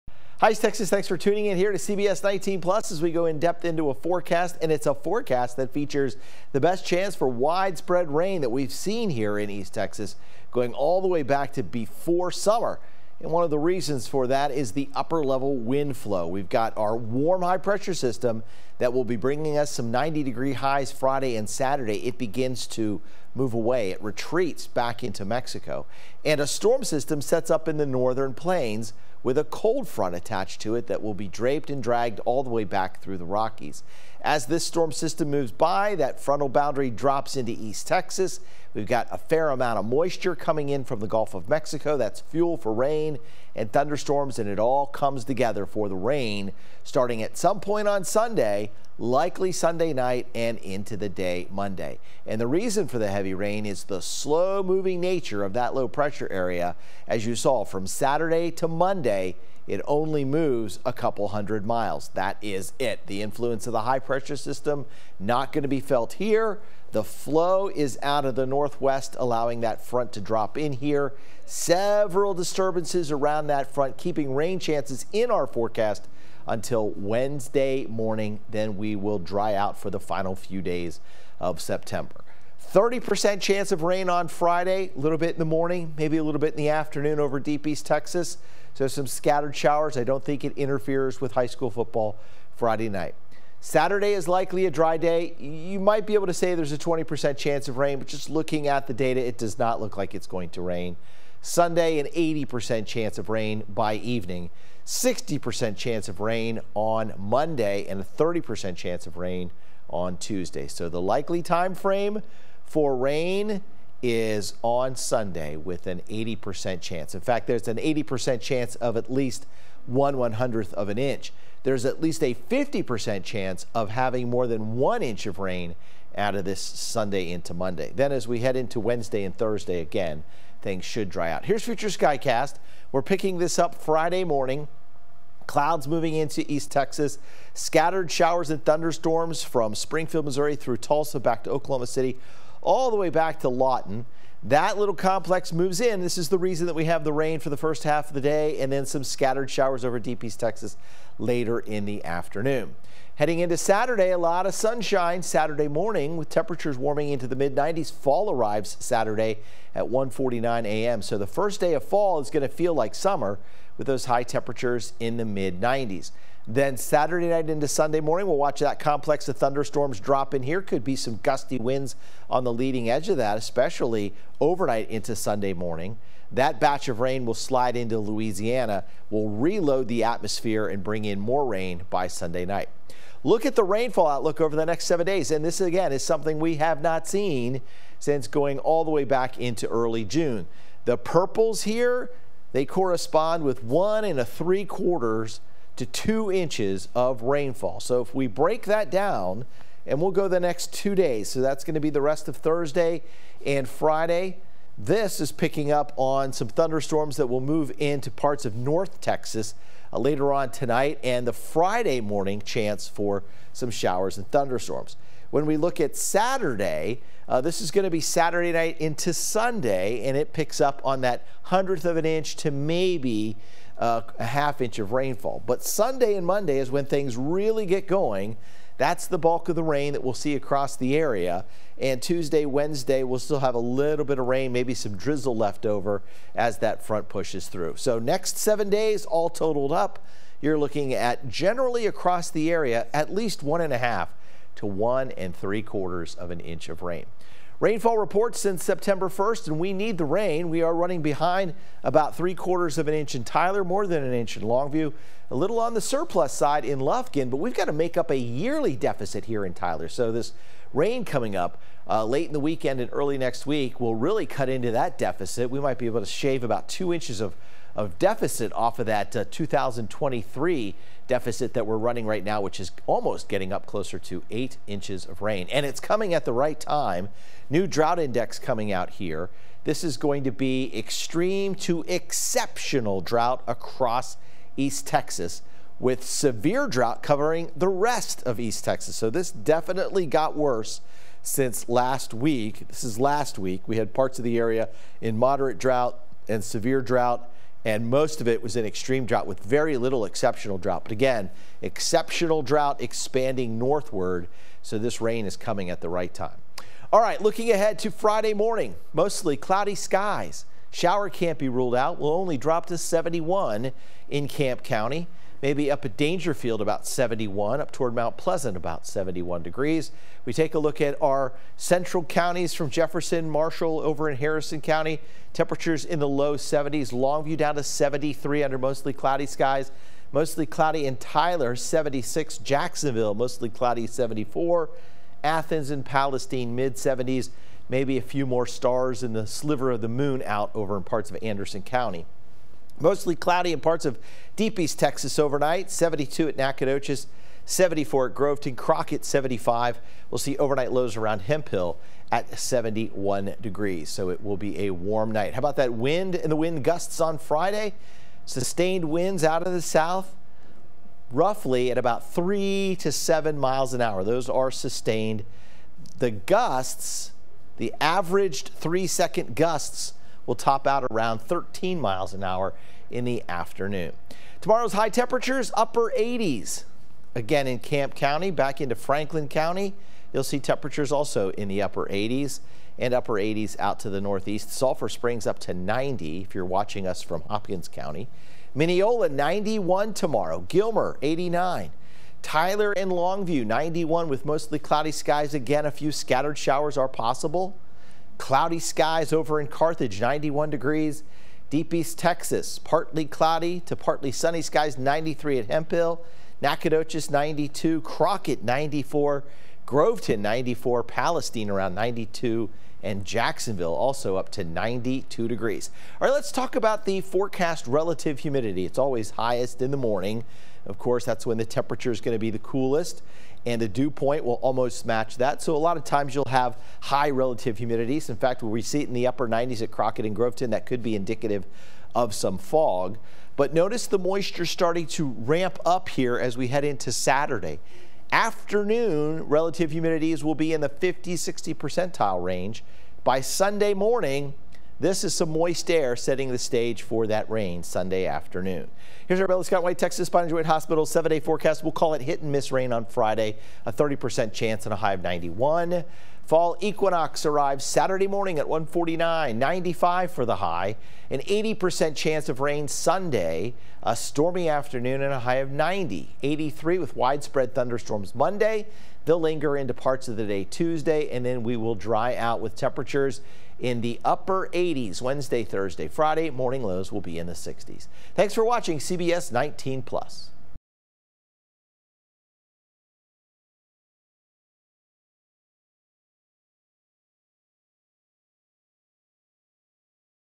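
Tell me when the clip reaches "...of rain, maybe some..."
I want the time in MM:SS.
03:54.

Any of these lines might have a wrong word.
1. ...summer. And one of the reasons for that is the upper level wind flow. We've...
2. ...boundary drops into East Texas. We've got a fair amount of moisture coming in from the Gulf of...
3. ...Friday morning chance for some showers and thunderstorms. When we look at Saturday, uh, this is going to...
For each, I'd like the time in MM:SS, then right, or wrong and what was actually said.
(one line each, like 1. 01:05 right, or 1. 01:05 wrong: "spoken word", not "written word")
1. 00:12 right
2. 00:36 right
3. 03:31 right.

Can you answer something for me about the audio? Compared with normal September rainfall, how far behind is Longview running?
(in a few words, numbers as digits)
more than an inch.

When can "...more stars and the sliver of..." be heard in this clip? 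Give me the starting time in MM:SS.
05:38.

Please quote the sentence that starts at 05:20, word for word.
We take a look at our central counties from Jefferson, Marshall over in Harrison County.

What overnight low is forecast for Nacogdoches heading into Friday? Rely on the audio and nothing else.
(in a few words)
72.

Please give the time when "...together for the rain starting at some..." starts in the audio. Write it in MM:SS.
00:45.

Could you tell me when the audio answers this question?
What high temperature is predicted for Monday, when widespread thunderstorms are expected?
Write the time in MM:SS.
07:46.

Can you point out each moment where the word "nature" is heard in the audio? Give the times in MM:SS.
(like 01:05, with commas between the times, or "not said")
00:54.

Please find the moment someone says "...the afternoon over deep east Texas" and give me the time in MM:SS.
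01:26.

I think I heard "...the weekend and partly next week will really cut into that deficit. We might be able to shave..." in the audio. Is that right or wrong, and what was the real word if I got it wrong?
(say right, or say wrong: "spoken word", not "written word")
wrong: "early", not "partly".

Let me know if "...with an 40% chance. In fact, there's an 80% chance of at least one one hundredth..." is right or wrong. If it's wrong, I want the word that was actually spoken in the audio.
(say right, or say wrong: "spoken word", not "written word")
wrong: "80", not "40".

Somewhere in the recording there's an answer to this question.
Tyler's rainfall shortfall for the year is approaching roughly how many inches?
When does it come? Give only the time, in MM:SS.
04:34.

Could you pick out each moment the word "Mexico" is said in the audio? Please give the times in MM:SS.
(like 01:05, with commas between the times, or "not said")
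00:25, 00:41.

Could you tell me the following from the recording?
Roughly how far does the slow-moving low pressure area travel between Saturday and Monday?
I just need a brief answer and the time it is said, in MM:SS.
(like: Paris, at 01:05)
a couple hundred miles, at 01:00.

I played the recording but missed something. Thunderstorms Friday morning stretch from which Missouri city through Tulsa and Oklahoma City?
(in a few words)
Springfield.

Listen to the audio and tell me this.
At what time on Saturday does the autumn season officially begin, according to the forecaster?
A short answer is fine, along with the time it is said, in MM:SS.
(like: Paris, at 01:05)
1:49 a.m., at 02:39.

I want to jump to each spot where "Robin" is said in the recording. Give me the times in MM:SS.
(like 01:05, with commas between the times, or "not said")
not said.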